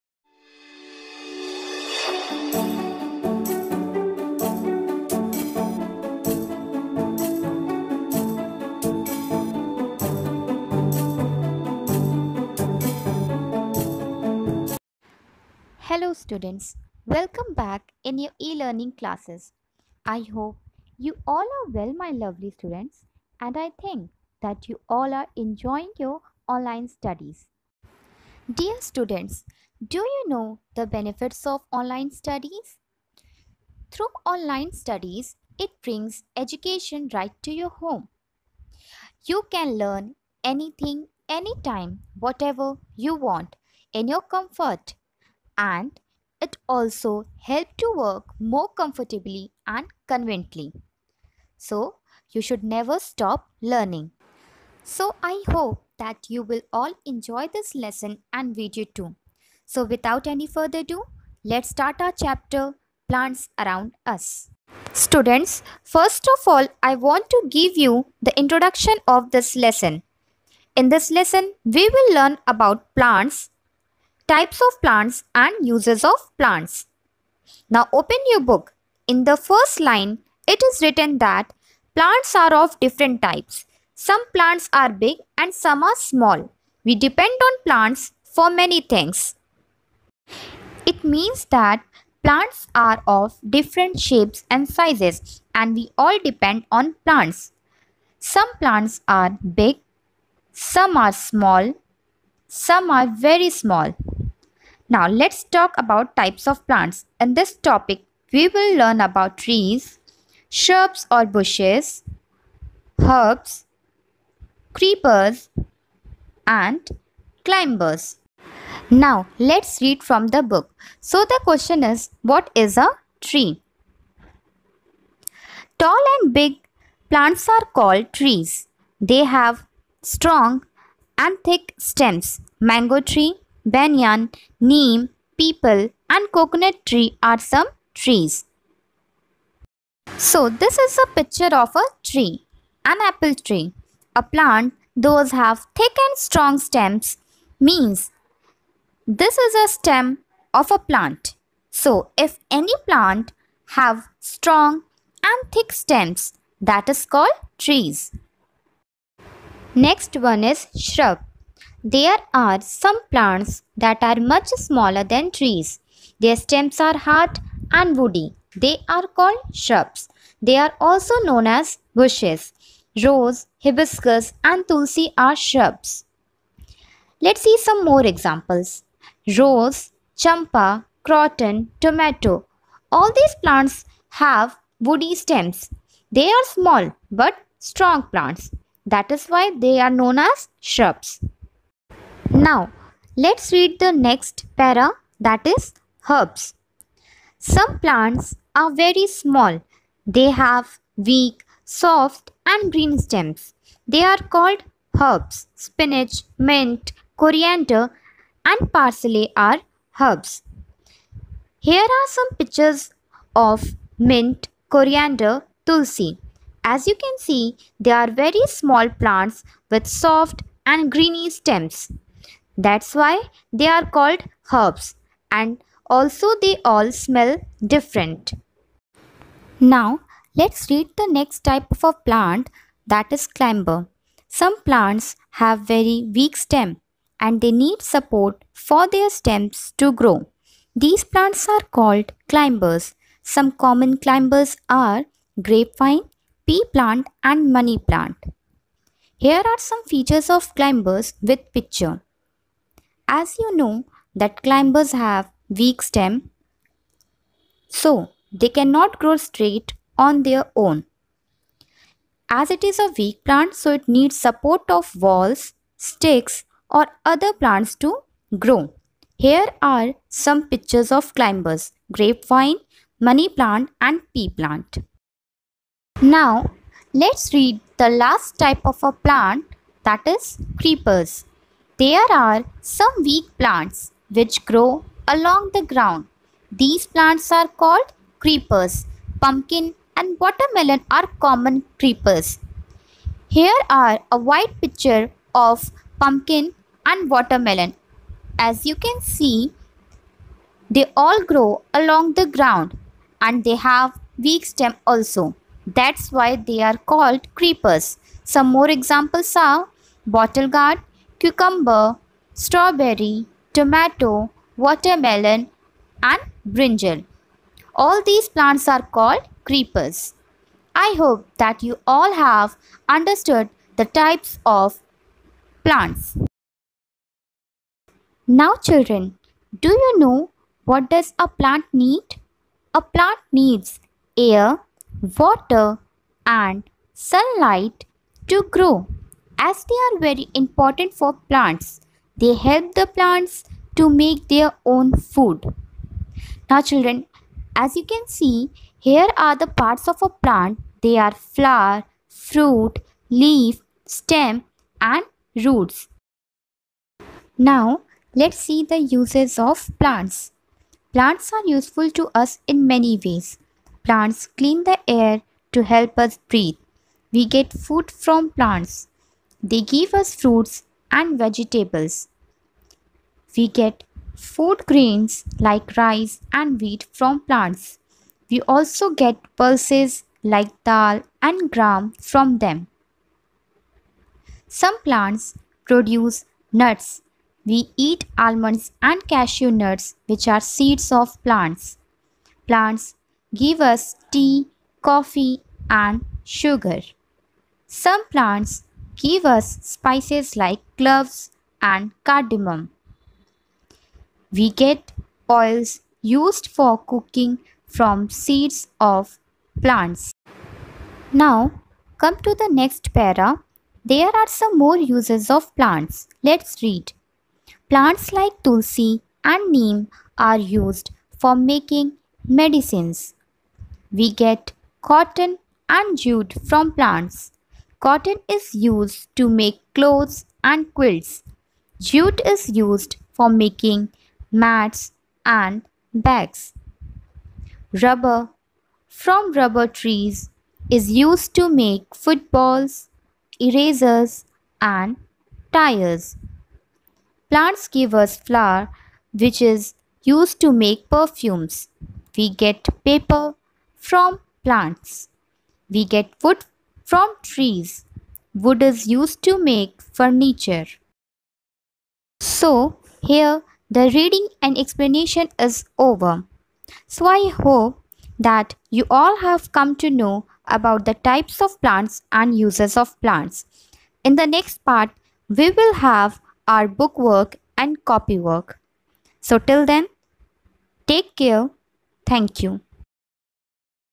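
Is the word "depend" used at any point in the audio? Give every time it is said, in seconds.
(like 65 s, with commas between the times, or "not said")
86 s, 96 s.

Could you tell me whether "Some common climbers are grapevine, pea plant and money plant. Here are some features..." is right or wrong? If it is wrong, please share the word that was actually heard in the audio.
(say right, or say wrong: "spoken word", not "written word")
right.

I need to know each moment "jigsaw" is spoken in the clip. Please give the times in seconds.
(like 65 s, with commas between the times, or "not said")
not said.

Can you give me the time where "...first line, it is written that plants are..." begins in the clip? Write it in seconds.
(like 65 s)
79 s.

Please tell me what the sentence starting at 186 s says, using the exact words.
They are small but strong plants.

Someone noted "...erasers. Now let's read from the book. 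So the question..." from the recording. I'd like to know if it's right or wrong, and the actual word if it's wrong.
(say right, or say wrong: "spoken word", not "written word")
wrong: "climbers", not "erasers".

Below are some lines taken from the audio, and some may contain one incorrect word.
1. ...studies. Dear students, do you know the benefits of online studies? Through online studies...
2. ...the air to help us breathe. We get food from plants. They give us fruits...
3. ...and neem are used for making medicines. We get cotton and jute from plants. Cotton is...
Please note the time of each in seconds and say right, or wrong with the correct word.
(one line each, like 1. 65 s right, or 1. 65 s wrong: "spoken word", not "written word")
1. 26 s right
2. 364 s right
3. 419 s right.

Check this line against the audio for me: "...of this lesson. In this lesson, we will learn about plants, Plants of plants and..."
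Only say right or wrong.
wrong.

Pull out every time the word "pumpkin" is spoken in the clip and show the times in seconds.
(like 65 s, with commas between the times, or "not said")
289 s, 296 s.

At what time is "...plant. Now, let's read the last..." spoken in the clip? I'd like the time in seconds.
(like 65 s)
274 s.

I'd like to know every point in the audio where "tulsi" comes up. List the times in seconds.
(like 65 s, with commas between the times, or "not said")
174 s, 215 s, 418 s.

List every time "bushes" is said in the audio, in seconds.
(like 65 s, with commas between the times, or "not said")
111 s, 171 s.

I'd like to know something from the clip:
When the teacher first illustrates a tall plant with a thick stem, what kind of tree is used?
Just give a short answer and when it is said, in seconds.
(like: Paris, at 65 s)
apple tree, at 142 s.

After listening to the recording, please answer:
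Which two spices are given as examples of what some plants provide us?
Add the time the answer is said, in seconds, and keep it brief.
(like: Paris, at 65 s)
cloves and cardamom, at 400 s.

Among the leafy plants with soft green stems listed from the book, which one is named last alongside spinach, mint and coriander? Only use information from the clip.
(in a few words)
parsley.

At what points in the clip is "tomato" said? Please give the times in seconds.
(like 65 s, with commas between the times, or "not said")
181 s, 313 s.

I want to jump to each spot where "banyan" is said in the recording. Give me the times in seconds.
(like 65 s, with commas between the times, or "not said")
133 s.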